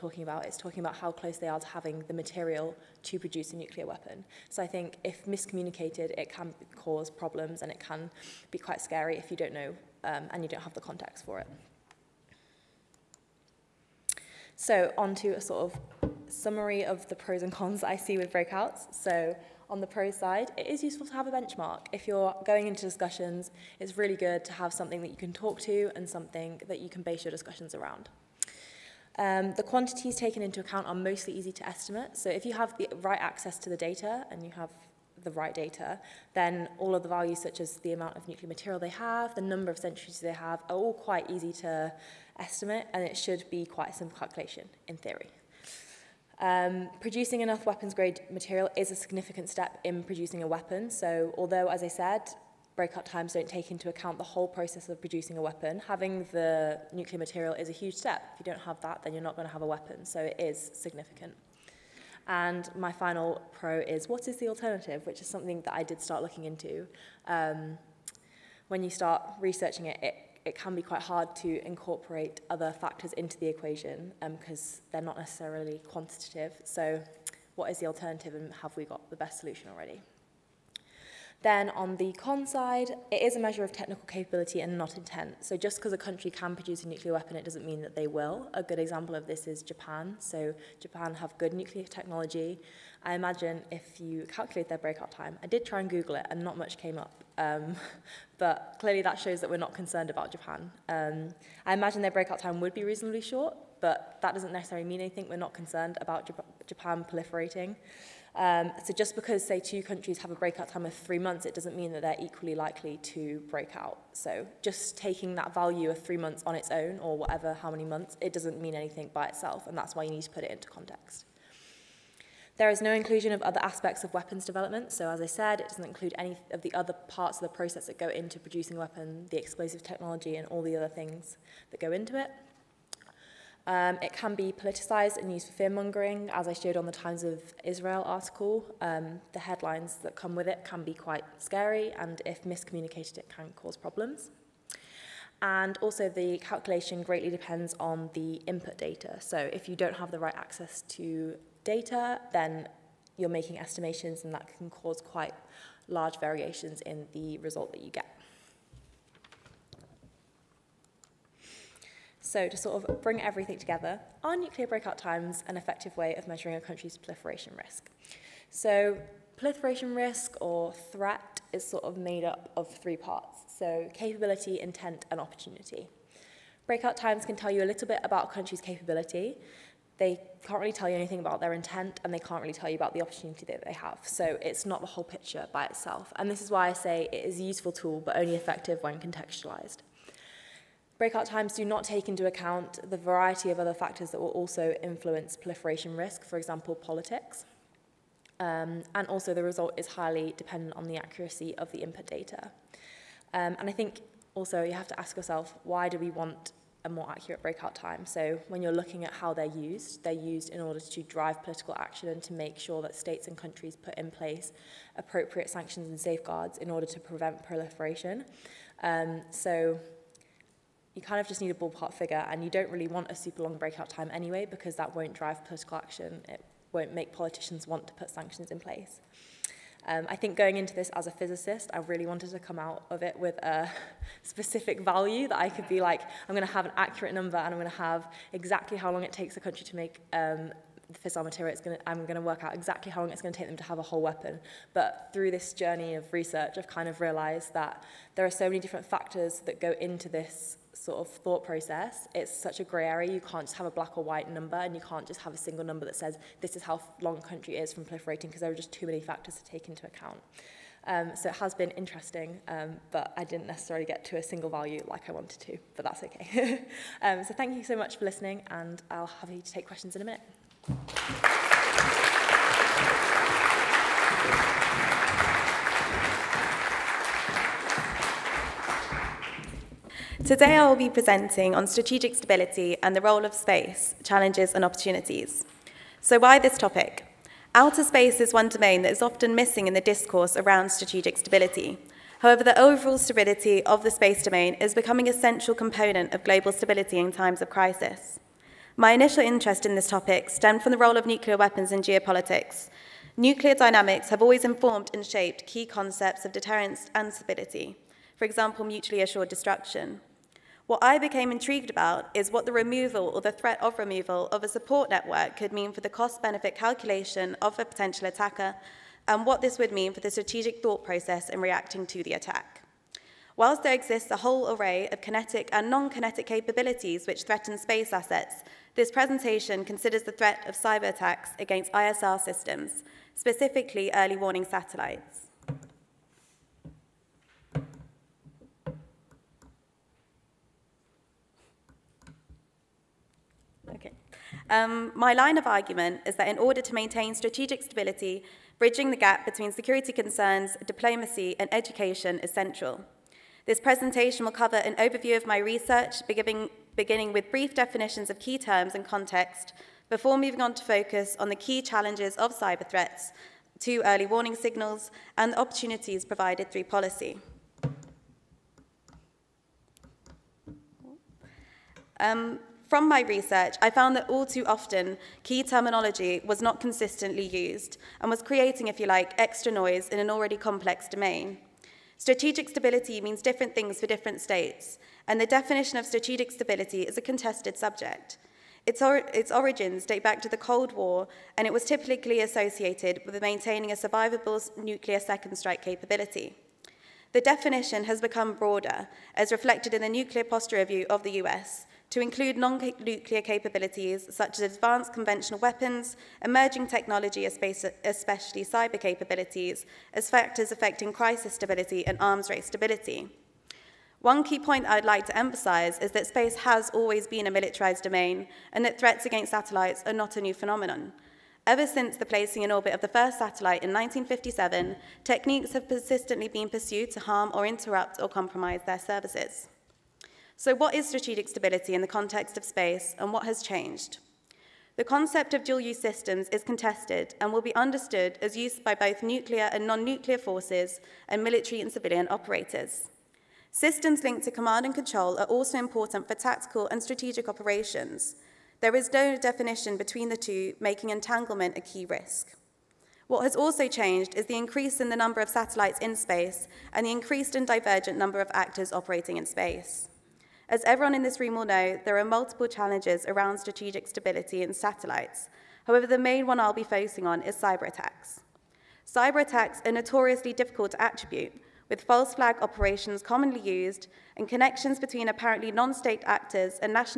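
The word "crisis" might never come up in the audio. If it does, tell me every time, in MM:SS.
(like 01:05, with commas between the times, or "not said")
04:57, 06:50.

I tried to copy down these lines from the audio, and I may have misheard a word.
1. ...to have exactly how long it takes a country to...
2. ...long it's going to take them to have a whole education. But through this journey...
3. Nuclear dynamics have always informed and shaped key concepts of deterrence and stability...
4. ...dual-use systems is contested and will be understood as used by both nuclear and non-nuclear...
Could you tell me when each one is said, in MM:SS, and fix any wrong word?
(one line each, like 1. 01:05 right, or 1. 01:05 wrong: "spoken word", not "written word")
1. 03:57 right
2. 04:03 wrong: "weapon", not "education"
3. 05:03 right
4. 07:15 right.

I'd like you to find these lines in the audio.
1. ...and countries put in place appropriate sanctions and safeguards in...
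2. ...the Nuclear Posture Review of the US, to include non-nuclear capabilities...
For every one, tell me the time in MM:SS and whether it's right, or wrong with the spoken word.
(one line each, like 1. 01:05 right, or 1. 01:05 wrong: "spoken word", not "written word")
1. 03:33 right
2. 06:39 right.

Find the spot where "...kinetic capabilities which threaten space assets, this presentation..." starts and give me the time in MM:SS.
05:25.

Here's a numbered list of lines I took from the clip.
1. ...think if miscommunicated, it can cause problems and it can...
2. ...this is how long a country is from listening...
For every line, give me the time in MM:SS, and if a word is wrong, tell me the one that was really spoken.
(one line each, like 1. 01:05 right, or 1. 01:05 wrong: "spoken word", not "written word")
1. 00:04 right
2. 04:16 wrong: "proliferating", not "listening".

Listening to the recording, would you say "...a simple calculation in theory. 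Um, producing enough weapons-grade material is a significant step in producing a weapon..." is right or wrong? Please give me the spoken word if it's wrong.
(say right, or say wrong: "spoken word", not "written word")
right.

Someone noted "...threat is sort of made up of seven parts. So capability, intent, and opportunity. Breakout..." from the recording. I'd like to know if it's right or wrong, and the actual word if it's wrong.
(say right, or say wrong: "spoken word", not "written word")
wrong: "three", not "seven".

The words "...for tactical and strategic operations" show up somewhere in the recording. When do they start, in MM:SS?
07:26.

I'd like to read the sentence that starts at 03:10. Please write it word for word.
Breakout times do not take into account the variety of other factors that will also influence proliferation risk, for example, politics.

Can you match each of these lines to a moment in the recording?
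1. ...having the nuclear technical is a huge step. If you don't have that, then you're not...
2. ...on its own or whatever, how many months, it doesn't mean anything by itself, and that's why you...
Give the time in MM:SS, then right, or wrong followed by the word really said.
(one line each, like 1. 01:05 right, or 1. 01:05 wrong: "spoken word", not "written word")
1. 00:55 wrong: "material", not "technical"
2. 01:56 right.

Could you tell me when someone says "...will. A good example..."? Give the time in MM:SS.
01:28.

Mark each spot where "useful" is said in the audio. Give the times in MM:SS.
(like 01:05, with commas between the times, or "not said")
00:20, 03:07.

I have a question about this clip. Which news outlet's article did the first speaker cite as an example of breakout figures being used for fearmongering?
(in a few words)
Times of Israel.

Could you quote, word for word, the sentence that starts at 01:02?
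And my final pro is what is the alternative, which is something that I did start looking into.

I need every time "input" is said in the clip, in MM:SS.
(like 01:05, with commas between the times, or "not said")
02:28, 03:21.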